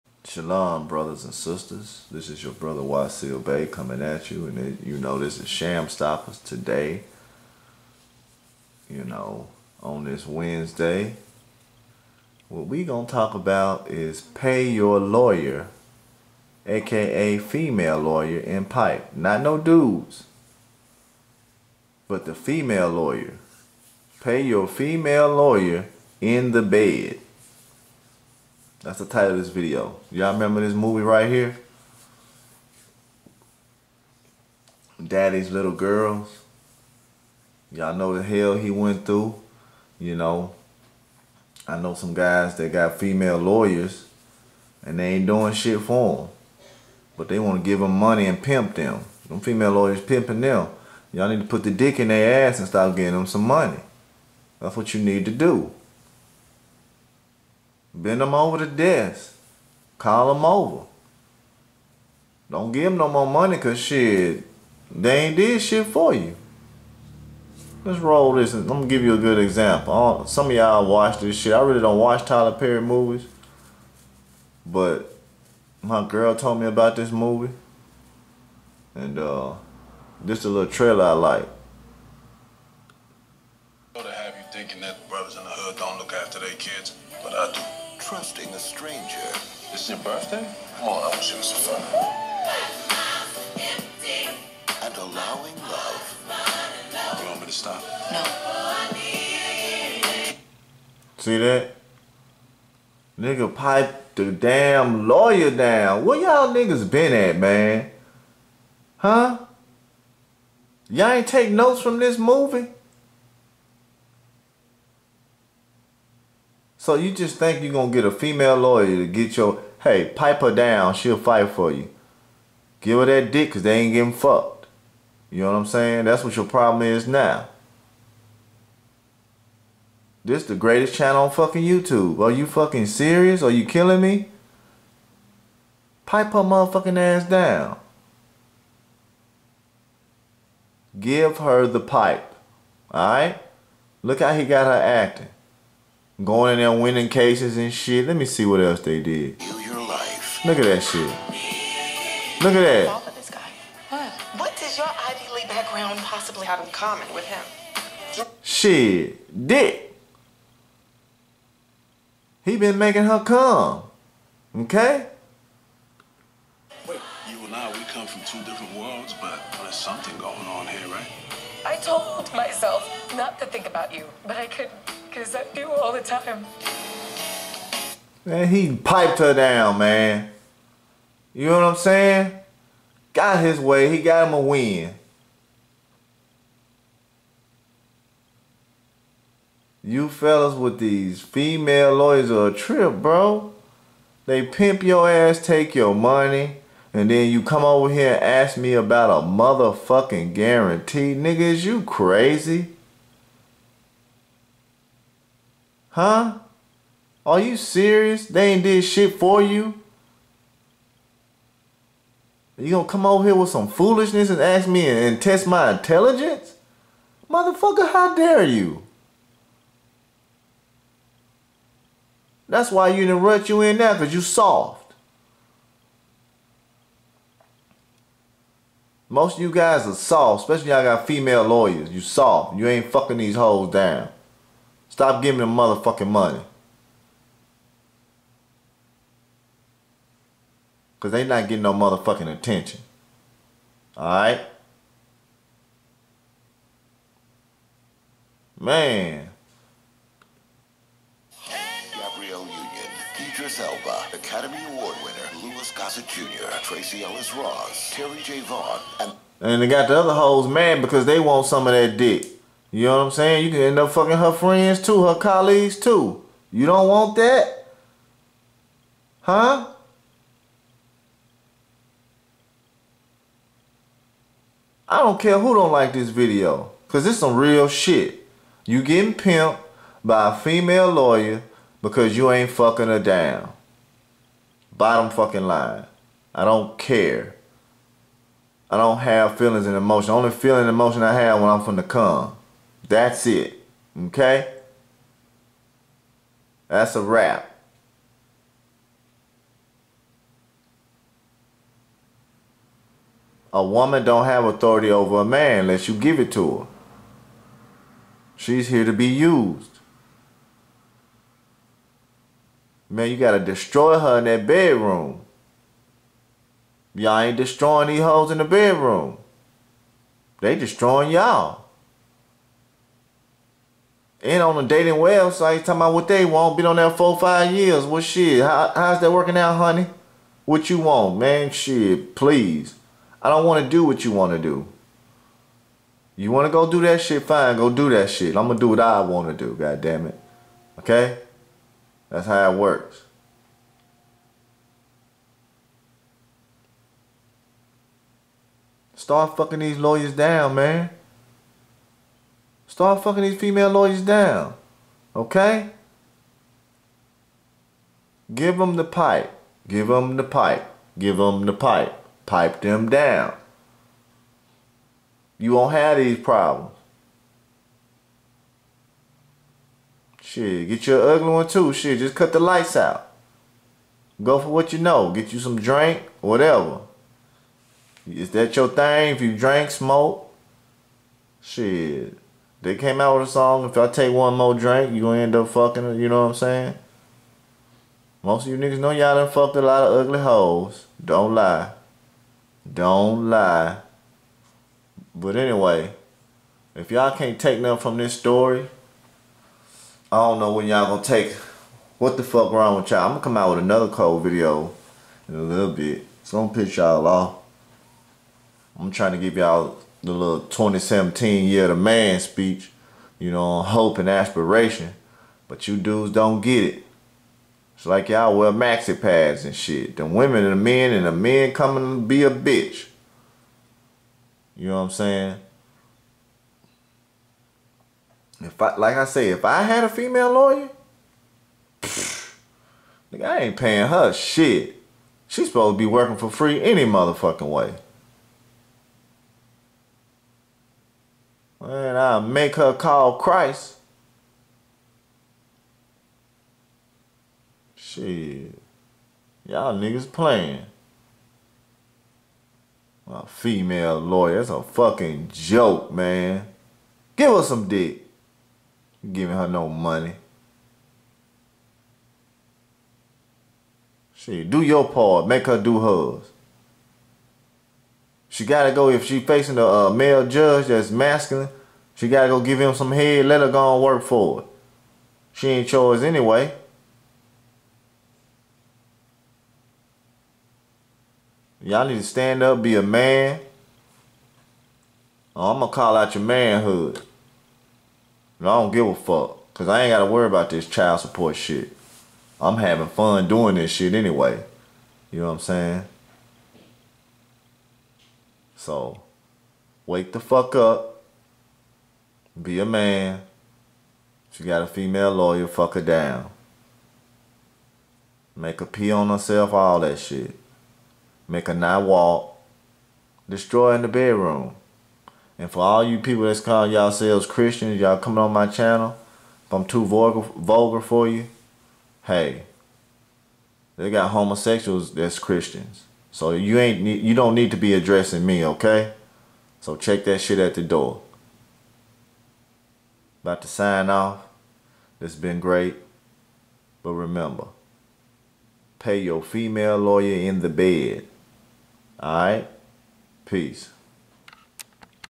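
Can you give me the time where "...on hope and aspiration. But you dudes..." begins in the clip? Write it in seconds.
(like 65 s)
413 s.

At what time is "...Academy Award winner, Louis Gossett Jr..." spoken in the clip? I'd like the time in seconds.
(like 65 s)
254 s.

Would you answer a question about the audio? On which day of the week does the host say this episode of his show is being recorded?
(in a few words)
Wednesday.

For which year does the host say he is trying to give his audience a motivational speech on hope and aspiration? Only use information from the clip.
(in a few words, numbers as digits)
2017.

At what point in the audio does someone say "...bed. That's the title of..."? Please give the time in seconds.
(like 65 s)
26 s.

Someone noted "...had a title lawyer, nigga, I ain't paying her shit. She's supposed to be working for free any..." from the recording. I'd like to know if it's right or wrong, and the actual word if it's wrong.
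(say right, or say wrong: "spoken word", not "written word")
wrong: "female", not "title".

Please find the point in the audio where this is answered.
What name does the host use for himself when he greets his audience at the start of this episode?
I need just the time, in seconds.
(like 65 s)
2 s.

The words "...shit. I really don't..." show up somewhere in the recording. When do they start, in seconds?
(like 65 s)
71 s.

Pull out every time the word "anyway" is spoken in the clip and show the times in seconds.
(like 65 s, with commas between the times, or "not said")
395 s, 476 s, 493 s.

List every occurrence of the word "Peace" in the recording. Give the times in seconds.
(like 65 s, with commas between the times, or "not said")
543 s.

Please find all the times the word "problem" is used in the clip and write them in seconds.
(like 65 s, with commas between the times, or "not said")
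126 s, 366 s.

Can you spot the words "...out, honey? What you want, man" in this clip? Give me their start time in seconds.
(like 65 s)
329 s.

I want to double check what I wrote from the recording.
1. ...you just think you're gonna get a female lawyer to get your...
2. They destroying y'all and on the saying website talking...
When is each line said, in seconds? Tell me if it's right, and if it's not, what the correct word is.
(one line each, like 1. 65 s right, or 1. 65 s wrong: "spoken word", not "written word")
1. 116 s right
2. 320 s wrong: "dating", not "saying".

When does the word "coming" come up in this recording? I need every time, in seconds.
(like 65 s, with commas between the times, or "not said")
3 s, 421 s, 517 s.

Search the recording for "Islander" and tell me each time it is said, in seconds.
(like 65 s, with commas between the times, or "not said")
not said.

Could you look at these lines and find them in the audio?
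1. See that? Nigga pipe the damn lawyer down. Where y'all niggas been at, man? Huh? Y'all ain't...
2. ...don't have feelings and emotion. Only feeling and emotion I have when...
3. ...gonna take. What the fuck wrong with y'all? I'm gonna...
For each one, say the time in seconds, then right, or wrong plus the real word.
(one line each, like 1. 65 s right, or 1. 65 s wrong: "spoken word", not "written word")
1. 101 s right
2. 288 s right
3. 400 s right.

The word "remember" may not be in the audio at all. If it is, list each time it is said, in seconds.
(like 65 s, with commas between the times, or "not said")
30 s, 536 s.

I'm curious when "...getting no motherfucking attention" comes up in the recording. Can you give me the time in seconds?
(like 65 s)
241 s.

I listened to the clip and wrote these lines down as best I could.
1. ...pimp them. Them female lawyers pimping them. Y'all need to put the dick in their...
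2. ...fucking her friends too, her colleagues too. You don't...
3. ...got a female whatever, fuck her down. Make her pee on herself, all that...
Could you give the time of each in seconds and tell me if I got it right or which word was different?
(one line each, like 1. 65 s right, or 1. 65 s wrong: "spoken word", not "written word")
1. 48 s right
2. 263 s right
3. 504 s wrong: "lawyer", not "whatever".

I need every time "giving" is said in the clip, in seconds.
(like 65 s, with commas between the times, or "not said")
235 s, 459 s.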